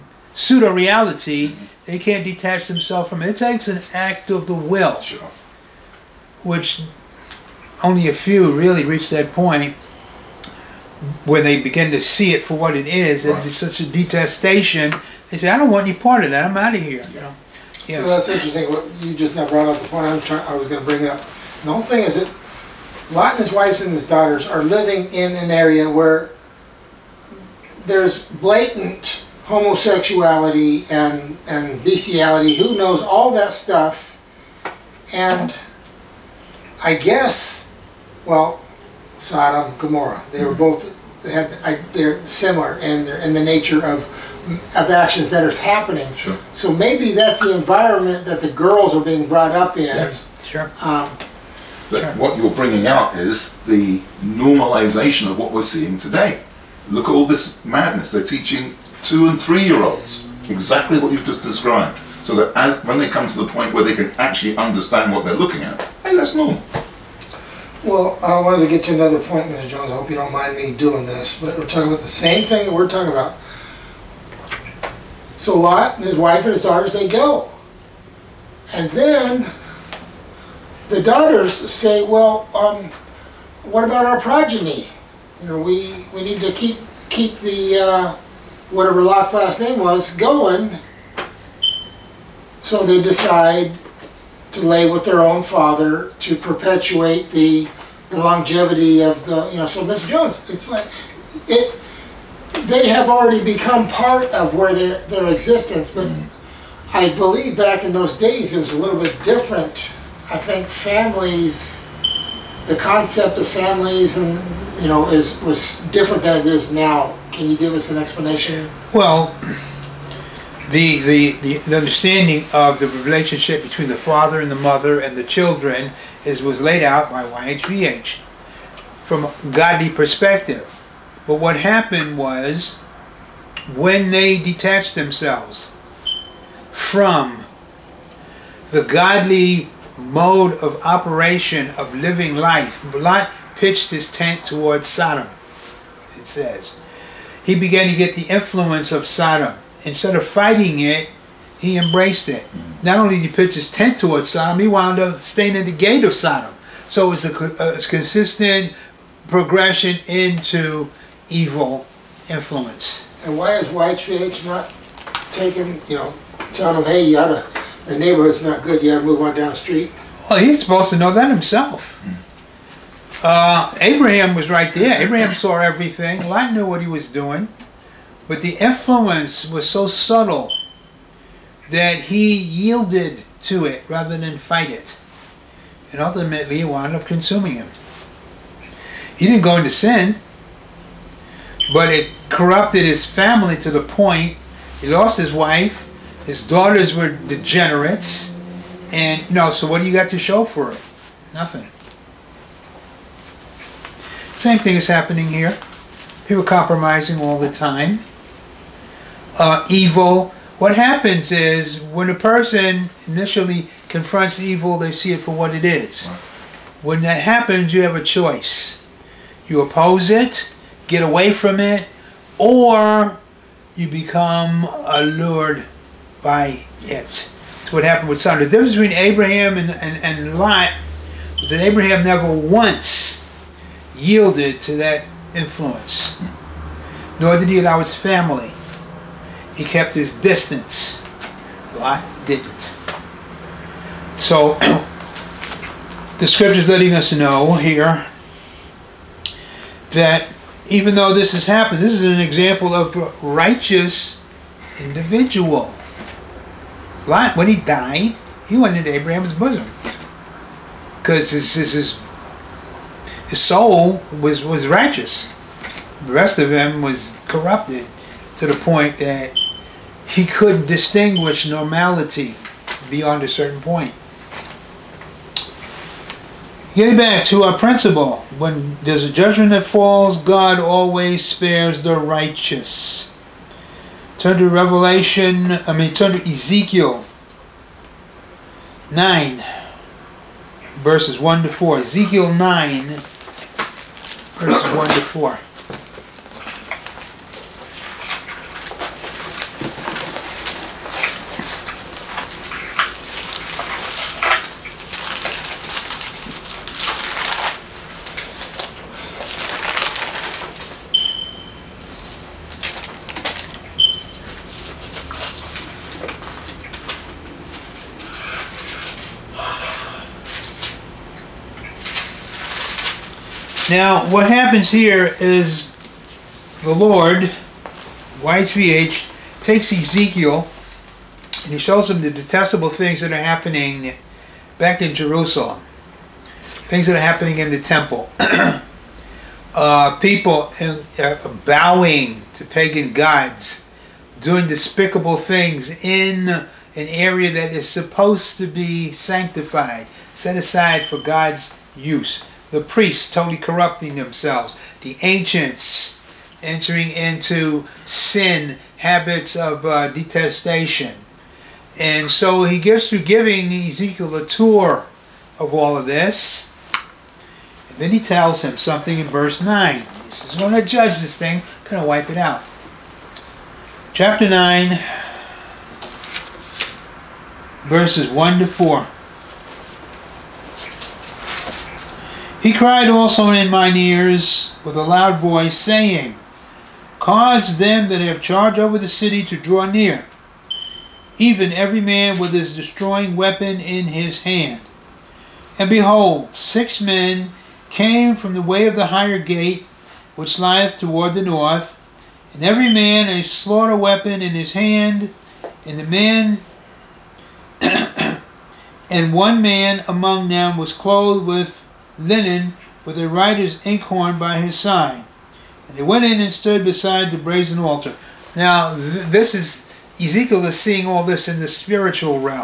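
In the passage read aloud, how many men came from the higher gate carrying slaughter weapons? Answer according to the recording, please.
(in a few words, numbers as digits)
6.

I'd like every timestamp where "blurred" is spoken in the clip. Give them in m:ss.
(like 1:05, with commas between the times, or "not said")
not said.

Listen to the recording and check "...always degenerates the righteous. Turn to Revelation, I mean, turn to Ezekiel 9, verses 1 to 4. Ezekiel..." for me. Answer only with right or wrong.
wrong.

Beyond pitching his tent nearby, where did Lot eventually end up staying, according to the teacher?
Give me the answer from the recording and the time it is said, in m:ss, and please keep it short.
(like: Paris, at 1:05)
The gate of Sodom, at 2:35.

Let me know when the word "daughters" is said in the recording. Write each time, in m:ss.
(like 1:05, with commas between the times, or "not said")
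0:24, 1:16, 1:21, 3:16.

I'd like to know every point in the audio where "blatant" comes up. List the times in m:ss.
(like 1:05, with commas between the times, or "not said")
0:28.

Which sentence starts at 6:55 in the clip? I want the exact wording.
And they went in and stood beside the brazen altar.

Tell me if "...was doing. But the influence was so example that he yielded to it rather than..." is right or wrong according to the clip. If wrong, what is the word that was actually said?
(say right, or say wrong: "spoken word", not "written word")
wrong: "subtle", not "example".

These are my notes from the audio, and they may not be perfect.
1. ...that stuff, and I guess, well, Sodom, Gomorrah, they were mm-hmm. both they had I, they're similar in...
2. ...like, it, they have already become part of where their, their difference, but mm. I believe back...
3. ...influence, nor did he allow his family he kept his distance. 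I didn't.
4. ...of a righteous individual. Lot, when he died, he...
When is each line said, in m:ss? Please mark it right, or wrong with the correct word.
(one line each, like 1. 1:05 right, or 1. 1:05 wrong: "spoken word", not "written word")
1. 0:33 right
2. 1:40 wrong: "existence", not "difference"
3. 3:55 right
4. 4:12 right.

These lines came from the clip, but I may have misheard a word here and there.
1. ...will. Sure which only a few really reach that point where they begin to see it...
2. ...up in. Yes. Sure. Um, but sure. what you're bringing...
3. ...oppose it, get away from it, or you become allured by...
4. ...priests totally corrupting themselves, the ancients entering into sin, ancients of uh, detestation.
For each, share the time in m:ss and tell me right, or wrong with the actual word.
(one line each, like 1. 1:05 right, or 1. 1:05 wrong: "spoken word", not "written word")
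1. 0:04 right
2. 0:49 right
3. 3:39 right
4. 5:52 wrong: "habits", not "ancients".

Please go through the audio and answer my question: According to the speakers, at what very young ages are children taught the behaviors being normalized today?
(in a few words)
2 and 3.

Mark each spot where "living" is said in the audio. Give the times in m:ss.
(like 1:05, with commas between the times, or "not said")
0:24, 2:21.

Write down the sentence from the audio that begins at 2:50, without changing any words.
Well, he's supposed to know that himself.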